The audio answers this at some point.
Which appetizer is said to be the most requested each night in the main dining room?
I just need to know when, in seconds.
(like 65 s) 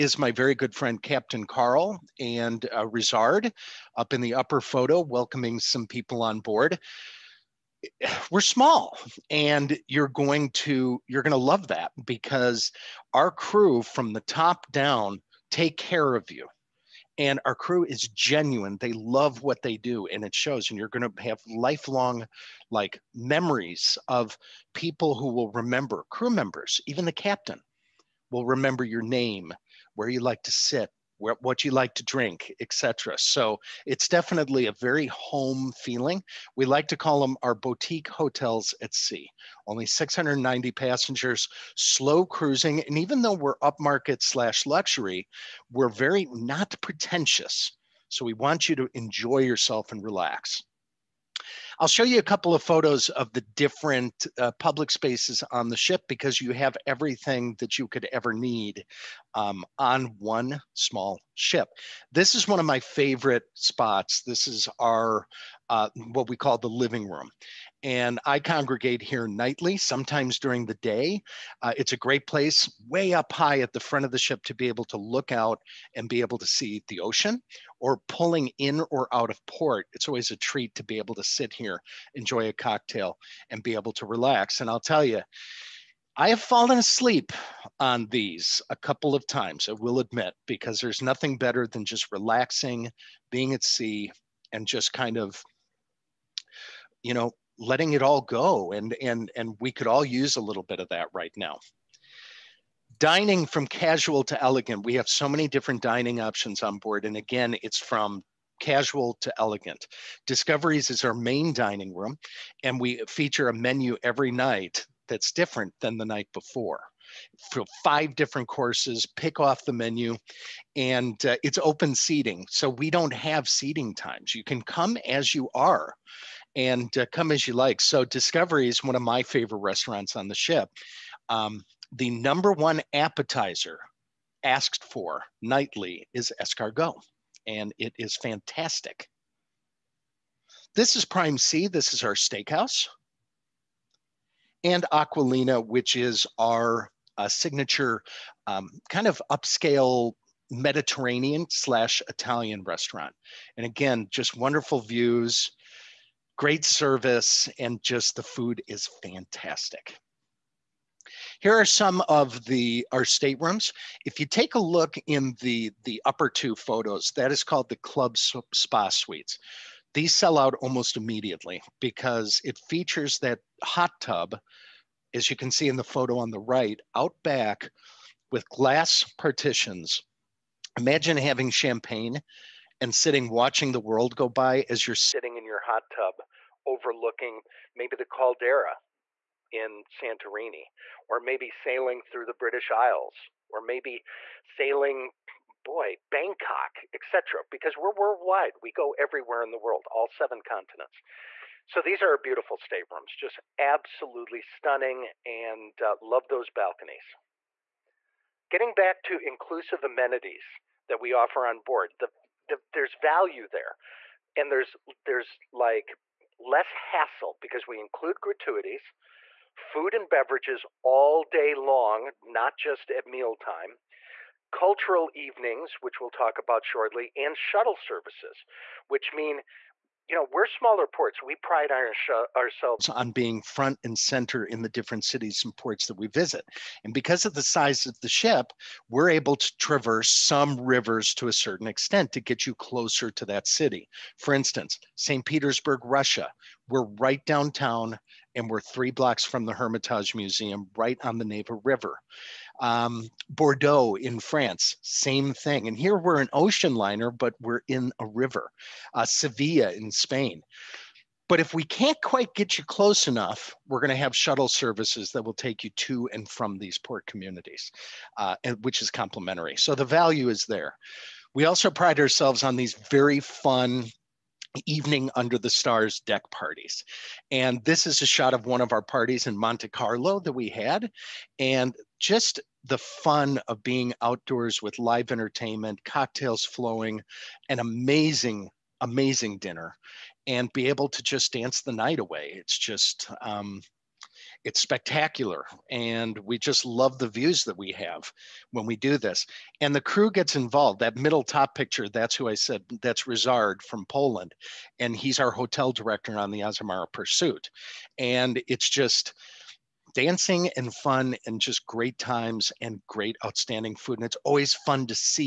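136 s.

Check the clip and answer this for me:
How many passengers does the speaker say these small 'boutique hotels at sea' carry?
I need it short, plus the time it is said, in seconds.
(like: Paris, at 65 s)
690, at 39 s.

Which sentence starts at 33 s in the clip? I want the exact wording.
So it's definitely a very home feeling.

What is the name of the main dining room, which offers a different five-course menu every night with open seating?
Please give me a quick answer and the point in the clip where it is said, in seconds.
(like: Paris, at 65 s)
Discoveries, at 110 s.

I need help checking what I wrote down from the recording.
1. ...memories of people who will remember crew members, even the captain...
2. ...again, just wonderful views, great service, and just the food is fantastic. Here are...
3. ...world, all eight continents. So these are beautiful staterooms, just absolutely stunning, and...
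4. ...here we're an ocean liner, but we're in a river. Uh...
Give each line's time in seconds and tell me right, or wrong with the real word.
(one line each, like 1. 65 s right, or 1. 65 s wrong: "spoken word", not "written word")
1. 23 s right
2. 153 s right
3. 199 s wrong: "seven", not "eight"
4. 255 s right.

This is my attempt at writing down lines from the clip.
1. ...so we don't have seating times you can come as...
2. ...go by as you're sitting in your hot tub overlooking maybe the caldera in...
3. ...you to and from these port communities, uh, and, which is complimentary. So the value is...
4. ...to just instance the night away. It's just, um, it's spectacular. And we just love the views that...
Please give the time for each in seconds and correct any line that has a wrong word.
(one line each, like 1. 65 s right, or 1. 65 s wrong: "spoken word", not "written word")
1. 122 s right
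2. 184 s right
3. 265 s right
4. 290 s wrong: "dance", not "instance".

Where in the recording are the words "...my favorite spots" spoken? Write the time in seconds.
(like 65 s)
62 s.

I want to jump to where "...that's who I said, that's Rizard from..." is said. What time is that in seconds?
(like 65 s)
301 s.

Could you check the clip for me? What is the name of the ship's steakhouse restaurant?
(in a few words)
Prime C.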